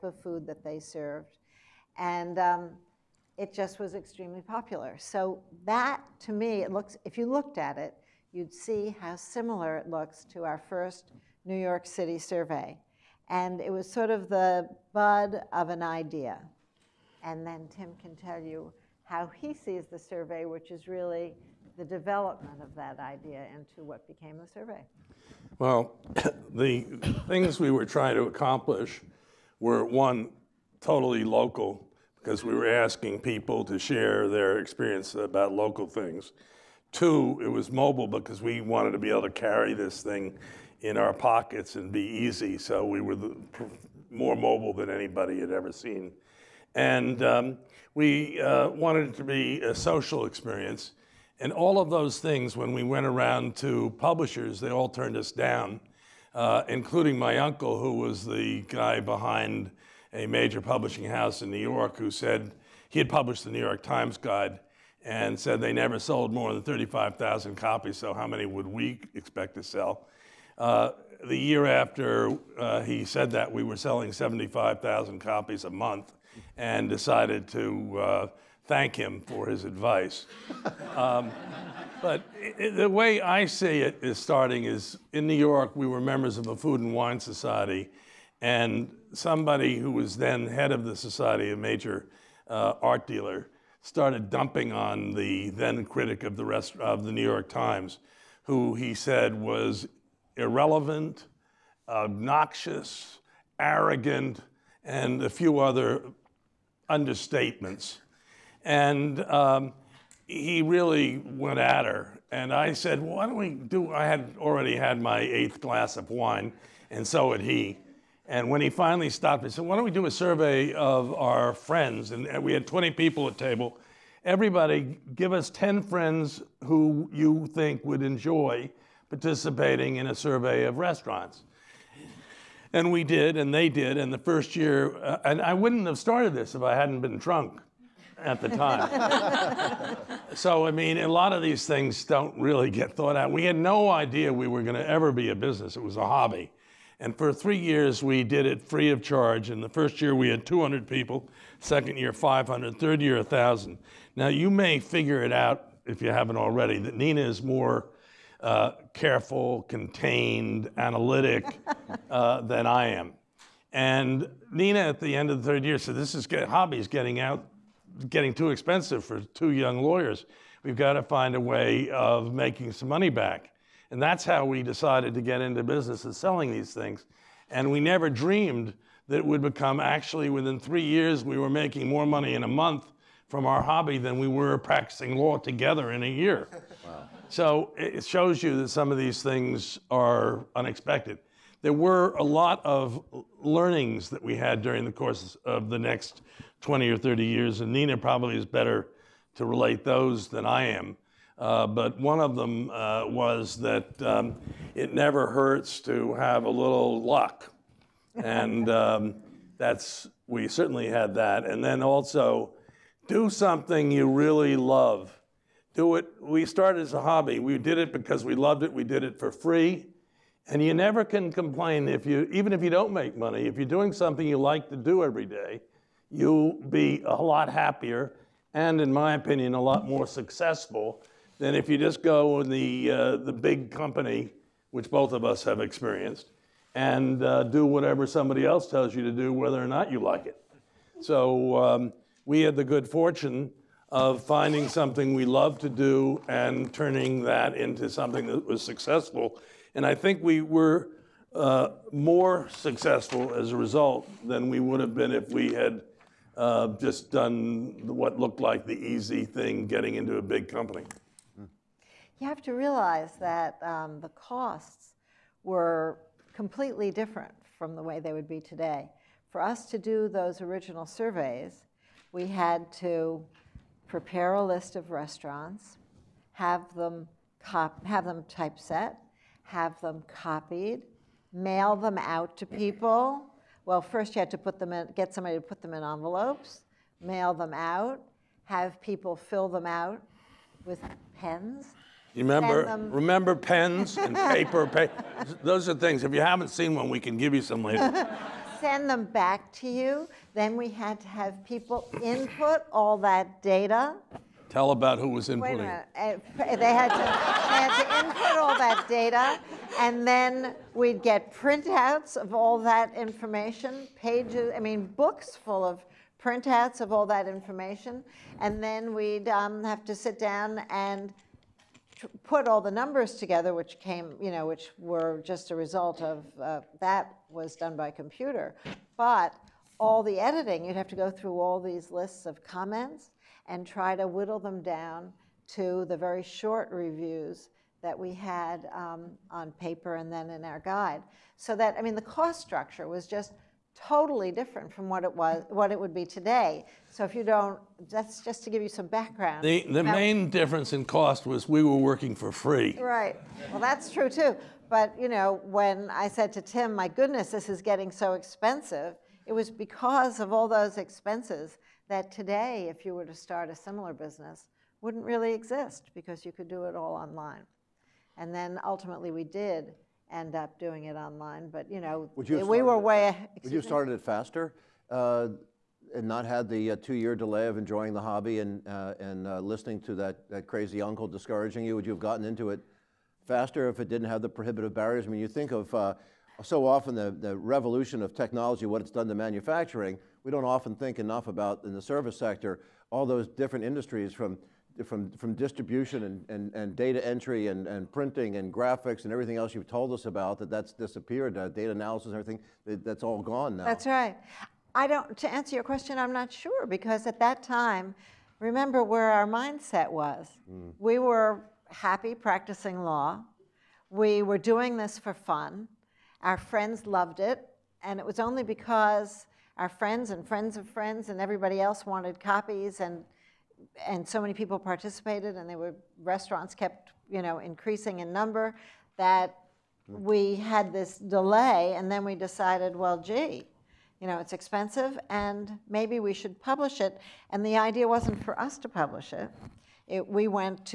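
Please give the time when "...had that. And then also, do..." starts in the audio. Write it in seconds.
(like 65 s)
210 s.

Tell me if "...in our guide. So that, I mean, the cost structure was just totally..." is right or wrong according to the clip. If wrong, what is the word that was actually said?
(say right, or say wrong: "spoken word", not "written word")
right.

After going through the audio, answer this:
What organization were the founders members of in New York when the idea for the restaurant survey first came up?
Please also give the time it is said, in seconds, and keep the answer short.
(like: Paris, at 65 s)
Food and Wine Society, at 86 s.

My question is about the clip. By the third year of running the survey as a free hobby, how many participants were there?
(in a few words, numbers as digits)
1,000.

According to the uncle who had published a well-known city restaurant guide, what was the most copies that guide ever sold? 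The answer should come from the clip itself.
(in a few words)
35,000.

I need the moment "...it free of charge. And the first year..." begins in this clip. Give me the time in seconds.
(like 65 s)
148 s.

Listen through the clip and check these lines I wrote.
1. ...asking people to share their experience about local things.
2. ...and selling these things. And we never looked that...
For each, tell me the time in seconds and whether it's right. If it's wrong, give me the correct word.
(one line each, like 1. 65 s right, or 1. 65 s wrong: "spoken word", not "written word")
1. 32 s right
2. 176 s wrong: "dreamed", not "looked".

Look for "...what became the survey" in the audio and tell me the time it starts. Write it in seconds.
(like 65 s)
23 s.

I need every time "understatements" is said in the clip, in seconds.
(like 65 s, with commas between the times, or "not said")
106 s.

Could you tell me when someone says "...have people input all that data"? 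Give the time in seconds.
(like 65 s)
301 s.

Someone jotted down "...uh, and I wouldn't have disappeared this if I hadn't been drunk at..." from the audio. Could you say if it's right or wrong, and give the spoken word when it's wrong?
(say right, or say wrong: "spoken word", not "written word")
wrong: "started", not "disappeared".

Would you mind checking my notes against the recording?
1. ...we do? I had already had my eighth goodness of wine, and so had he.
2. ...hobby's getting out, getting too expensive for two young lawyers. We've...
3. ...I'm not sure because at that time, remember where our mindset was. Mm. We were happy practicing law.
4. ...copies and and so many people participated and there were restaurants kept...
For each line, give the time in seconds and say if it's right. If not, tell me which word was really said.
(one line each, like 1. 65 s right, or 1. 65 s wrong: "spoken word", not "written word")
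1. 113 s wrong: "glass", not "goodness"
2. 166 s right
3. 405 s right
4. 422 s right.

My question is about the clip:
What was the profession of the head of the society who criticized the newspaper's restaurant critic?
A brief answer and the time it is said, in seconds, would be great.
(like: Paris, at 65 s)
art dealer, at 92 s.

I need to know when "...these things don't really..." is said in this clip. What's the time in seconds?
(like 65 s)
141 s.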